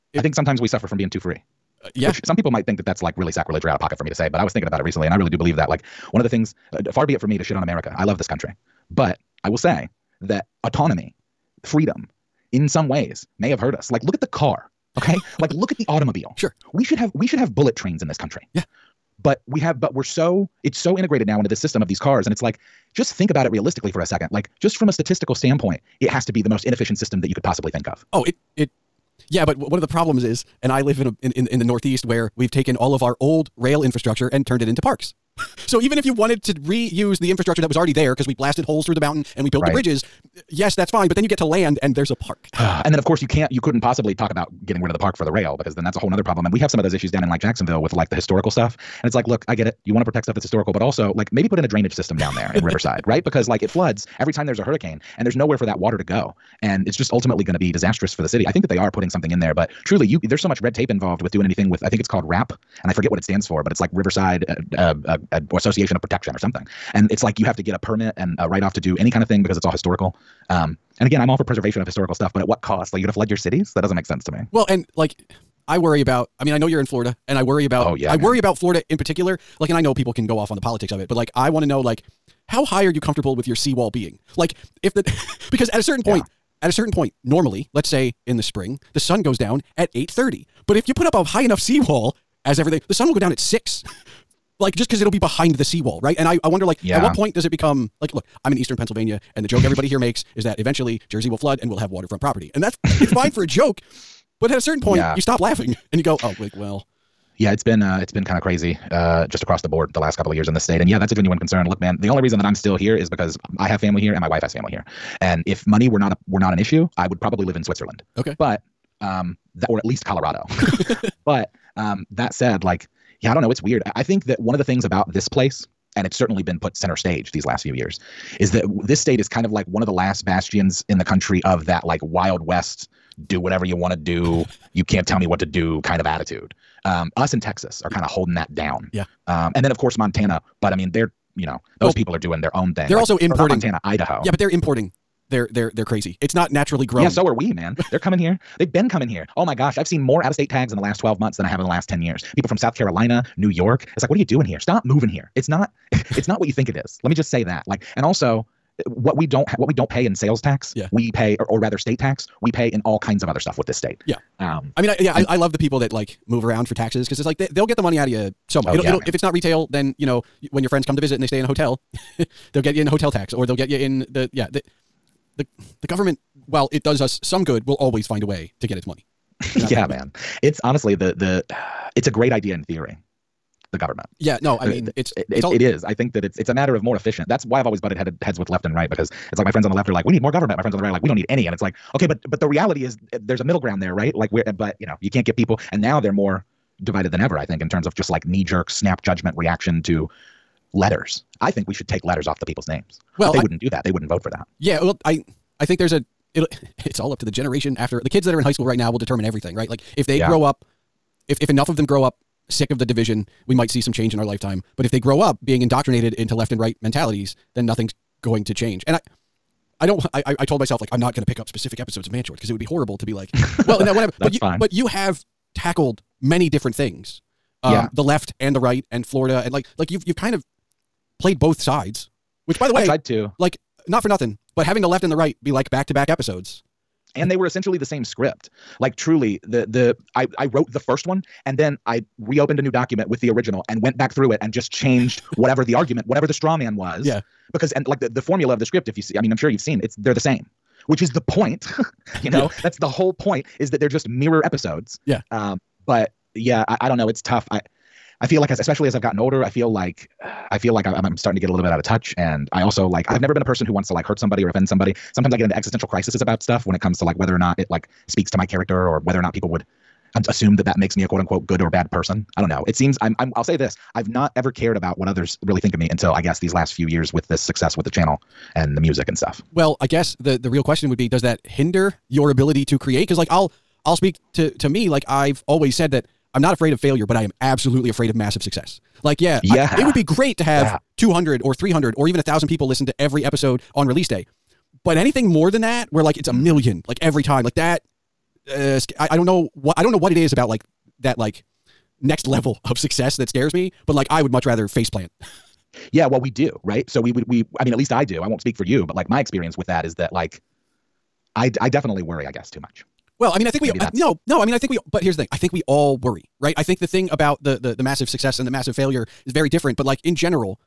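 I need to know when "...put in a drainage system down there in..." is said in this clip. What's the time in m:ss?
0:51.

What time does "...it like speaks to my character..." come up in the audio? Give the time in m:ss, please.
4:27.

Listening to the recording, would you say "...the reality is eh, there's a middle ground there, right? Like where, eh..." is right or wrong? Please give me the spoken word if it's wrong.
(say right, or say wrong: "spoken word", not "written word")
right.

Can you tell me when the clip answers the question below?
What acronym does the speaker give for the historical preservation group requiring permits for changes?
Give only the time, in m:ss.
1:02.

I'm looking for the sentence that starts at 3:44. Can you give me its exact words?
but you have tackled many different things.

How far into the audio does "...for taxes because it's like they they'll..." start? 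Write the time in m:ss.
2:46.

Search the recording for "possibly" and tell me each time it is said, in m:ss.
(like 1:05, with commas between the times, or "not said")
0:27, 0:43.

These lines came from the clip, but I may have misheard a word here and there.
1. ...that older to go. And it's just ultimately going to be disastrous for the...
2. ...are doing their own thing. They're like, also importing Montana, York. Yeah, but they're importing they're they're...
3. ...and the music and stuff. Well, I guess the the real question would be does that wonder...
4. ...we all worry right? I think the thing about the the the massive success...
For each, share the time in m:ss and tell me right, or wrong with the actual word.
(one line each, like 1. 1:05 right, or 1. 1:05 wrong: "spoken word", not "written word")
1. 0:55 wrong: "water", not "older"
2. 2:22 wrong: "Idaho", not "York"
3. 4:38 wrong: "hinder", not "wonder"
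4. 5:15 right.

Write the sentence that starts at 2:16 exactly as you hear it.
Um, us in Texas are kind of holding that down.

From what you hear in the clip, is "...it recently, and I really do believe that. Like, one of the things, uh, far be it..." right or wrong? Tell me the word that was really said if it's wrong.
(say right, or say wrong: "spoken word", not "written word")
right.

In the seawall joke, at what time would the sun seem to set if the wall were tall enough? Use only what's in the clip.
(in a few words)
6.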